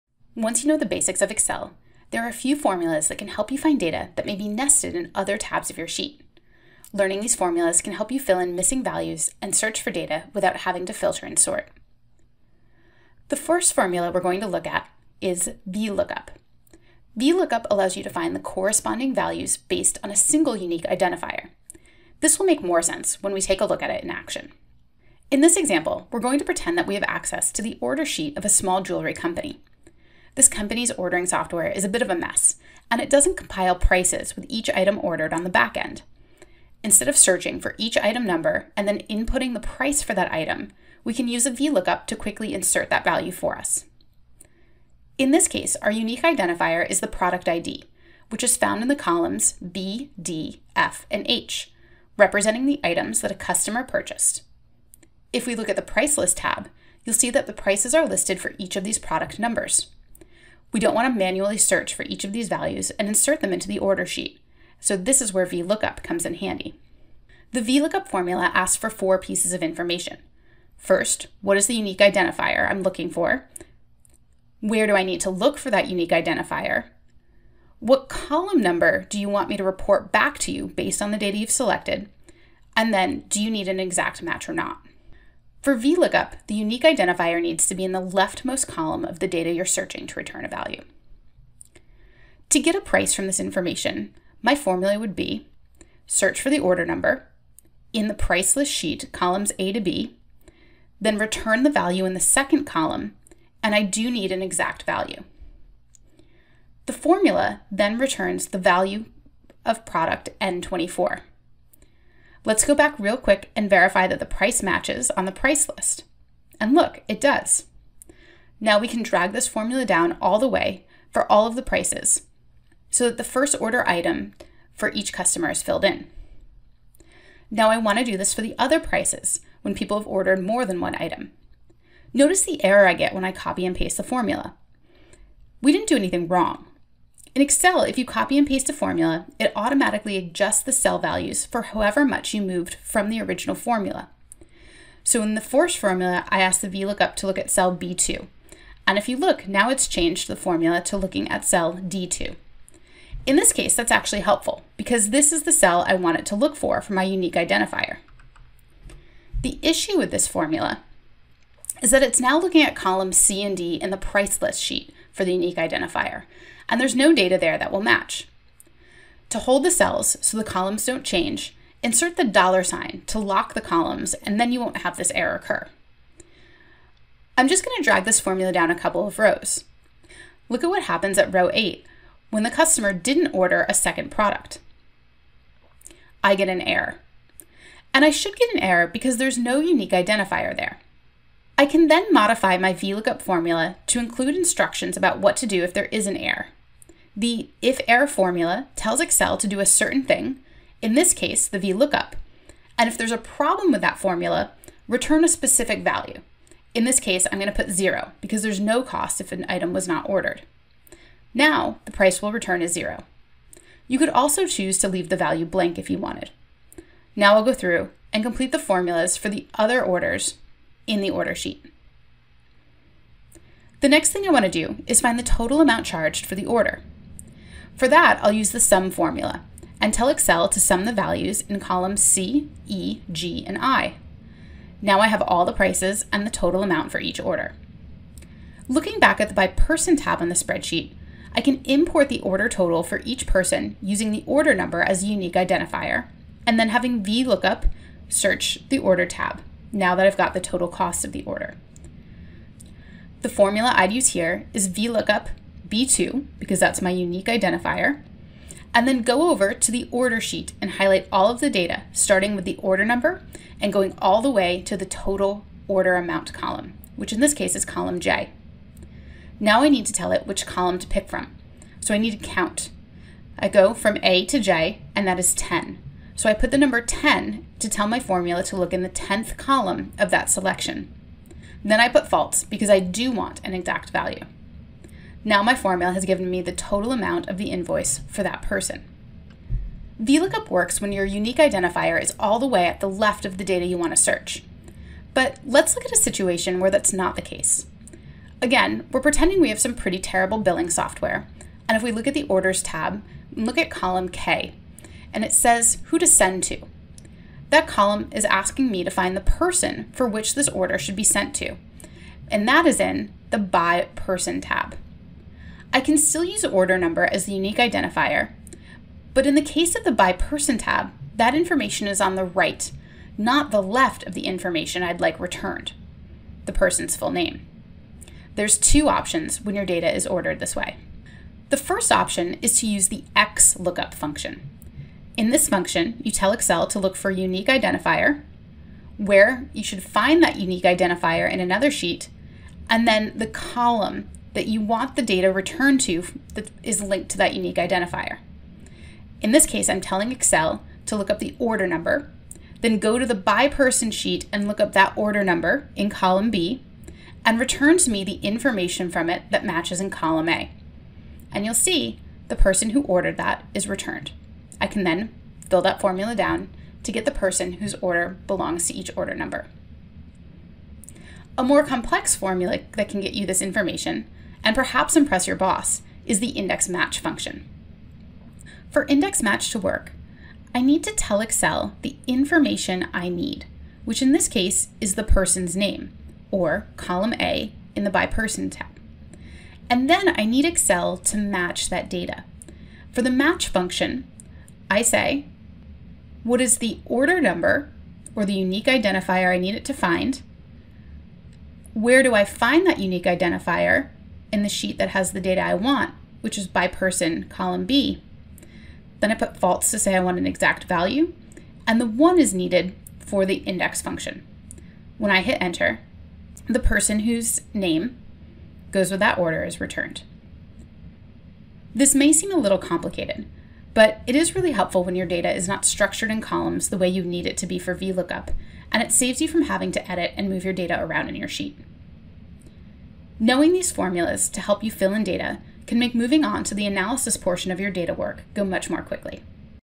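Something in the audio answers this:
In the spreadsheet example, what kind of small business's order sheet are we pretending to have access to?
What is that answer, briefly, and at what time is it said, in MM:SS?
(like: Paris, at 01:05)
Jewelry company, at 00:28.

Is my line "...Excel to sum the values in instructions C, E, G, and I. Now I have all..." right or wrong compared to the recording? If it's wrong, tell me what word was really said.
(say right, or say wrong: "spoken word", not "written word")
wrong: "columns", not "instructions".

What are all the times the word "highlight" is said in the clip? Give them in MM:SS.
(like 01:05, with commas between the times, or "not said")
04:20.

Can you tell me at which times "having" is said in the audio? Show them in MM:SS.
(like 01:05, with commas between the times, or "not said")
00:10, 04:06, 07:09.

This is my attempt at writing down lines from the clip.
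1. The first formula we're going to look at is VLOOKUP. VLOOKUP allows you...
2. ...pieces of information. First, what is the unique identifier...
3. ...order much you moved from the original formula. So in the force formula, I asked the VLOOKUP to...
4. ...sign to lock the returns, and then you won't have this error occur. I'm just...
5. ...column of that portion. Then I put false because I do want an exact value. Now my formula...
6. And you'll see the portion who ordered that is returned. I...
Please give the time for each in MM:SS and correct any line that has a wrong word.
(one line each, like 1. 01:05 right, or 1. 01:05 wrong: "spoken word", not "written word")
1. 00:13 right
2. 01:09 right
3. 02:21 wrong: "however", not "order"
4. 02:52 wrong: "columns", not "returns"
5. 04:39 wrong: "selection", not "portion"
6. 06:01 wrong: "person", not "portion".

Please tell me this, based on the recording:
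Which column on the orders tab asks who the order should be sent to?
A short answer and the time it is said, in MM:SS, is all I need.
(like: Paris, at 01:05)
Column K, at 05:03.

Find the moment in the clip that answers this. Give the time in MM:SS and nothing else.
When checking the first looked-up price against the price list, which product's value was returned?
01:50.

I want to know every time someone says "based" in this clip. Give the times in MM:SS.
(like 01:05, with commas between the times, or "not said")
00:19, 01:20.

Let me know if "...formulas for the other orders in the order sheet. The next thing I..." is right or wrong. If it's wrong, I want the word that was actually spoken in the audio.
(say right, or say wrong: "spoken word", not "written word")
right.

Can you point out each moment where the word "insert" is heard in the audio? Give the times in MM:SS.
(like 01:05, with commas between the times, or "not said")
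00:42, 01:03, 02:51.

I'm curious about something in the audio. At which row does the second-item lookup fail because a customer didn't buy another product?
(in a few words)
Row 8.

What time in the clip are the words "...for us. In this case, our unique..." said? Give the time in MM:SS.
00:43.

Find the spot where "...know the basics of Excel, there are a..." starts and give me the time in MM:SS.
00:00.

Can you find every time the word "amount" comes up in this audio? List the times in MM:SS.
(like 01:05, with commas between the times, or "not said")
03:45, 03:56, 04:25, 04:46.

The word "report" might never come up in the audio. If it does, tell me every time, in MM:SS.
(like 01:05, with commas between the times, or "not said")
01:19.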